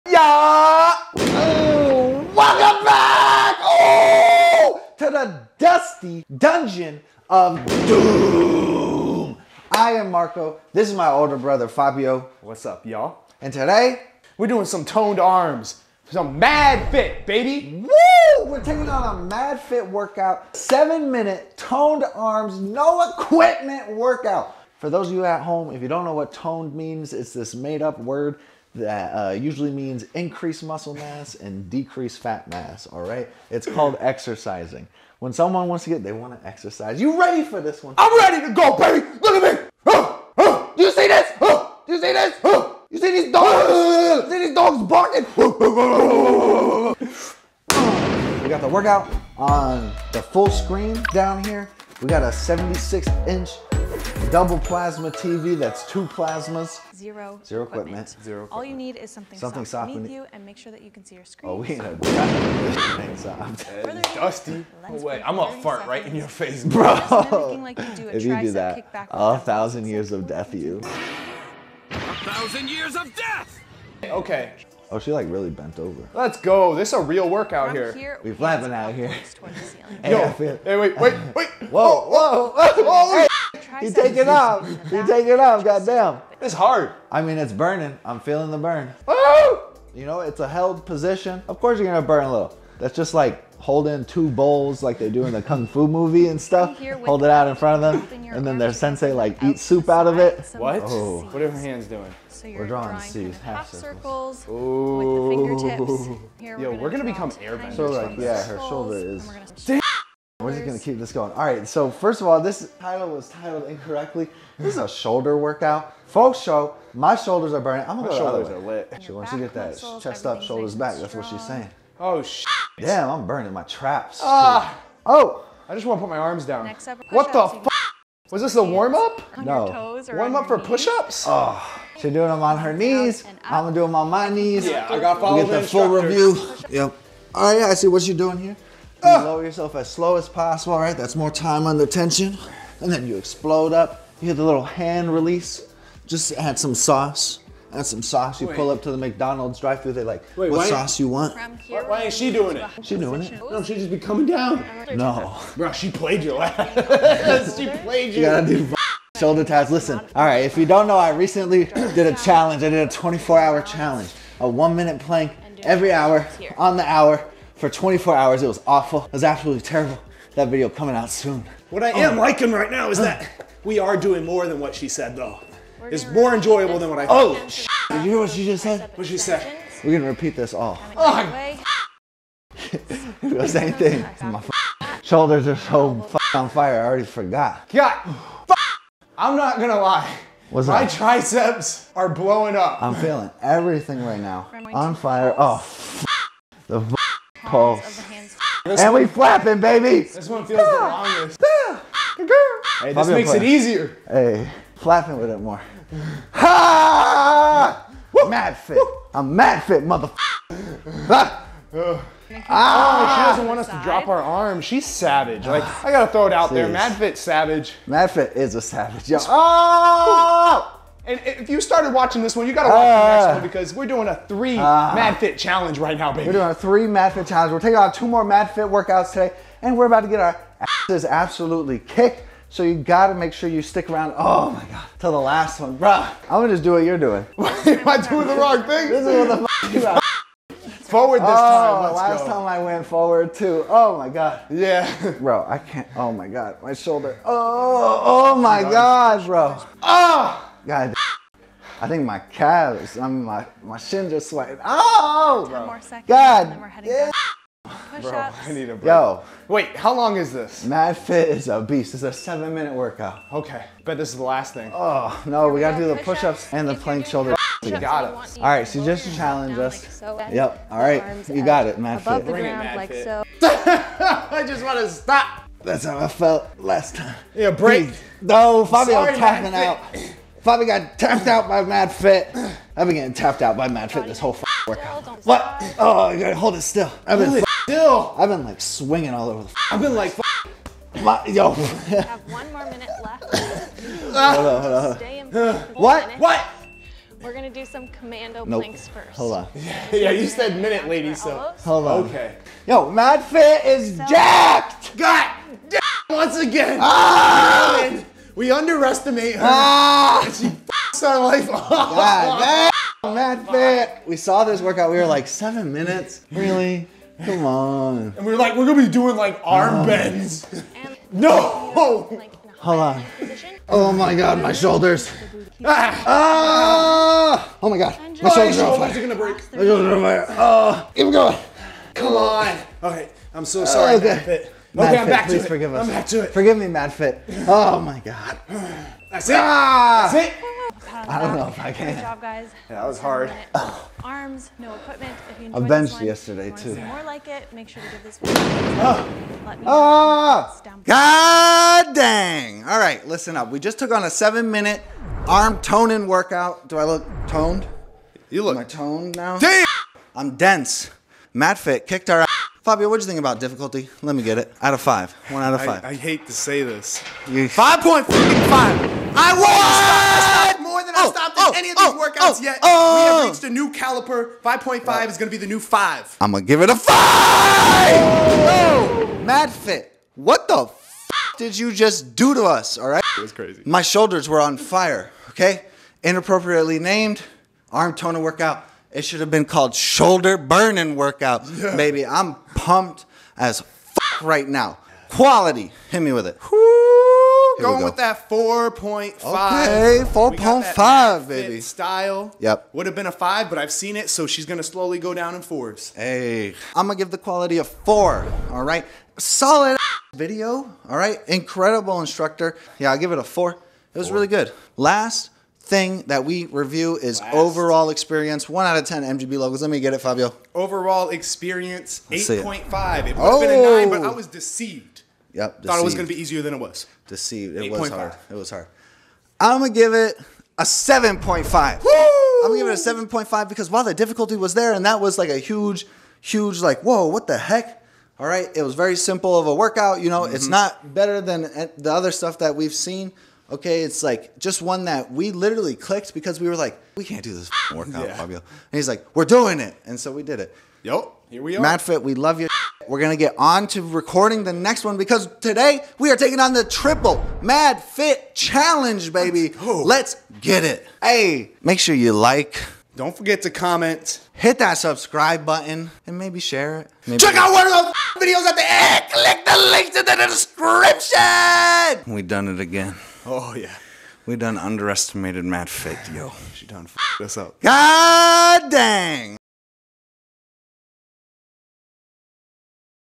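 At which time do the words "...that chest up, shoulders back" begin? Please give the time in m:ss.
1:59.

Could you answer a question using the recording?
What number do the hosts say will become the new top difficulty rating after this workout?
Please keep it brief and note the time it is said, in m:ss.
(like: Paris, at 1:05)
5.5, at 6:14.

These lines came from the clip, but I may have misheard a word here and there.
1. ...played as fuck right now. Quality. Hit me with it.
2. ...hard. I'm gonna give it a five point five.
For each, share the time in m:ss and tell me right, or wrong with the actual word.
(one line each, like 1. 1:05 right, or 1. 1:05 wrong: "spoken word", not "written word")
1. 6:32 wrong: "pumped", not "played"
2. 7:08 wrong: "seven", not "five".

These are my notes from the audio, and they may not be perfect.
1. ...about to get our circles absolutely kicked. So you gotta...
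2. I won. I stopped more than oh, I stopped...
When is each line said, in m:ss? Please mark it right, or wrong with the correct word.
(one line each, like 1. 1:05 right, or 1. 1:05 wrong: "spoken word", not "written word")
1. 3:49 wrong: "asses", not "circles"
2. 6:07 right.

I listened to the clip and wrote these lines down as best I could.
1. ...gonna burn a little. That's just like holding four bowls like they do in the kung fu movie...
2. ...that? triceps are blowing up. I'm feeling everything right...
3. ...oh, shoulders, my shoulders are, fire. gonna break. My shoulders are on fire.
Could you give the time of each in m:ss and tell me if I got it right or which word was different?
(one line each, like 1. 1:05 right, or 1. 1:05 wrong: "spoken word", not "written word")
1. 1:31 wrong: "two", not "four"
2. 3:10 right
3. 5:28 right.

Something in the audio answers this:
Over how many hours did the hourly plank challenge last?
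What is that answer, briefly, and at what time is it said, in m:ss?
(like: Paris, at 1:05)
24 hours, at 2:47.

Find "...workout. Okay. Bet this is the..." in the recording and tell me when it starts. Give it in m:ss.
4:22.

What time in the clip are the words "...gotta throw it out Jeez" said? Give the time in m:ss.
3:35.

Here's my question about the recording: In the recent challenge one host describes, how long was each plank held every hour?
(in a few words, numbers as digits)
one minute.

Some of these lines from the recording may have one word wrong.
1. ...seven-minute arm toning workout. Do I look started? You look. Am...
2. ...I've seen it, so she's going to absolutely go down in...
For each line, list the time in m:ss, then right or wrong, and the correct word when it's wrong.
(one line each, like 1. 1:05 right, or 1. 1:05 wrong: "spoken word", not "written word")
1. 5:54 wrong: "toned", not "started"
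2. 6:43 wrong: "slowly", not "absolutely".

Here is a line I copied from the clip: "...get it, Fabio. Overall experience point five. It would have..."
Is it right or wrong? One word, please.
right.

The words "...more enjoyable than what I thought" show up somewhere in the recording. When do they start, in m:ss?
2:56.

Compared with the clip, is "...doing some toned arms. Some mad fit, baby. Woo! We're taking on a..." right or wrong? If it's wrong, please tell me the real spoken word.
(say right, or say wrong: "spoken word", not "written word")
right.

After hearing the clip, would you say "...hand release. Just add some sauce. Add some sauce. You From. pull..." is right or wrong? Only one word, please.
wrong.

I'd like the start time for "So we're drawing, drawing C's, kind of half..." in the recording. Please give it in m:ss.
1:42.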